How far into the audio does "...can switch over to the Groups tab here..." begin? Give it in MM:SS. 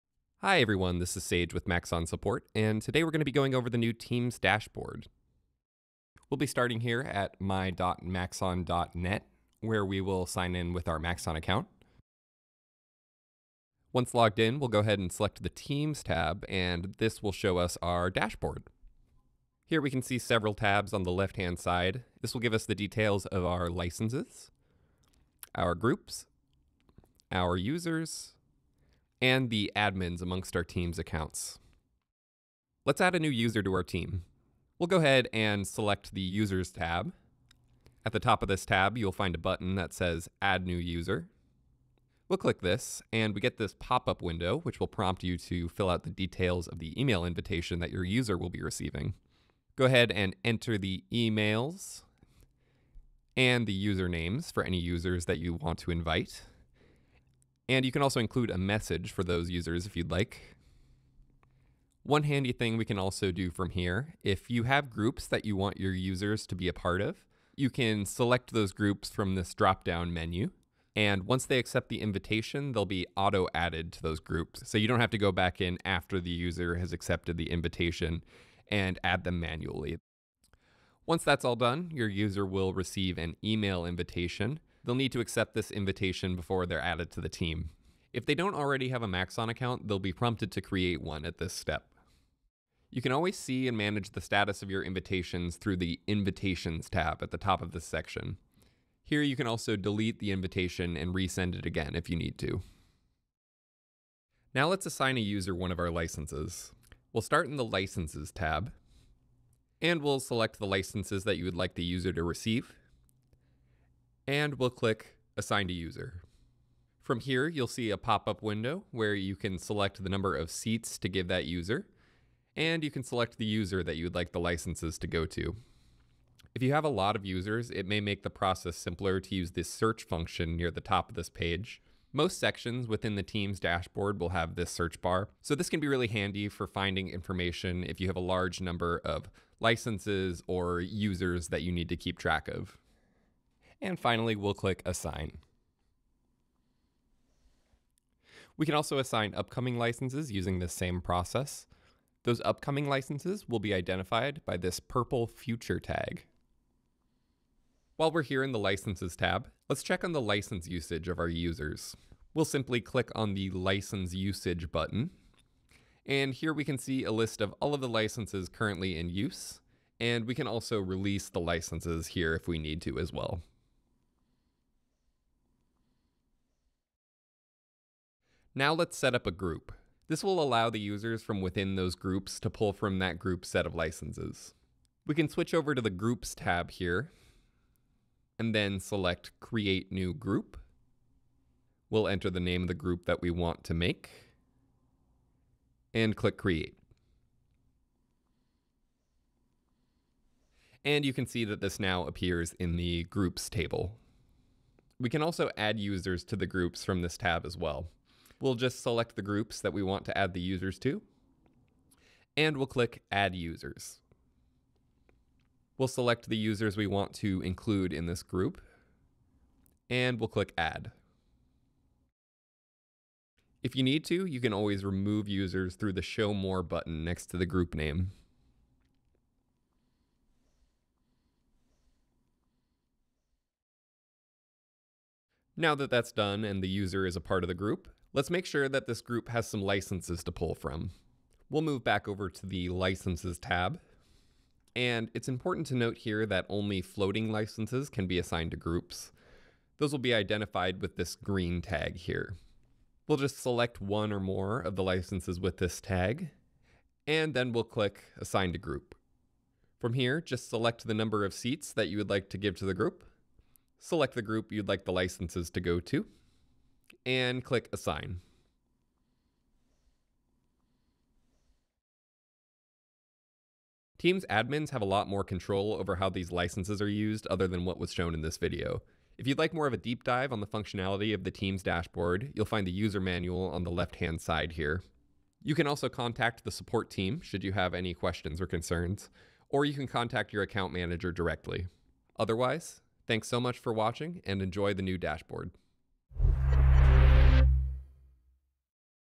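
03:05.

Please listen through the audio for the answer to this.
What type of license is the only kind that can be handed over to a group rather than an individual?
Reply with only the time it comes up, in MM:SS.
04:06.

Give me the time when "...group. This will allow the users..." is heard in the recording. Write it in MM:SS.
02:59.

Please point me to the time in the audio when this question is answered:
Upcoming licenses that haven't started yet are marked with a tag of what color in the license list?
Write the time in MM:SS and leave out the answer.
02:34.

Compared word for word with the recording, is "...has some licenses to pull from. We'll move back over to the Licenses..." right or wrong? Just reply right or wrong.
right.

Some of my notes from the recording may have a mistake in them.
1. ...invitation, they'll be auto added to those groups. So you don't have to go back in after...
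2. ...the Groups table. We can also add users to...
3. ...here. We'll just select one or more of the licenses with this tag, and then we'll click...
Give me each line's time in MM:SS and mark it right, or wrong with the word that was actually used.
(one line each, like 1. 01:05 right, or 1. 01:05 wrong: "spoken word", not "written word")
1. 01:12 right
2. 03:22 right
3. 04:11 right.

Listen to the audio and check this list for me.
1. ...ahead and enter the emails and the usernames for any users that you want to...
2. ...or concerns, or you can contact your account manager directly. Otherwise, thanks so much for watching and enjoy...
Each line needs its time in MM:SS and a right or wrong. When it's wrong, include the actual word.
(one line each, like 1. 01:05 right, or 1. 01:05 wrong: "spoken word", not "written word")
1. 00:49 right
2. 04:48 right.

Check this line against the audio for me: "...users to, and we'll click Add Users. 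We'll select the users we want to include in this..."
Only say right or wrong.
right.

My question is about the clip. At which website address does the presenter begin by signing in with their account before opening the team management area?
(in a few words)
my.maxon.net.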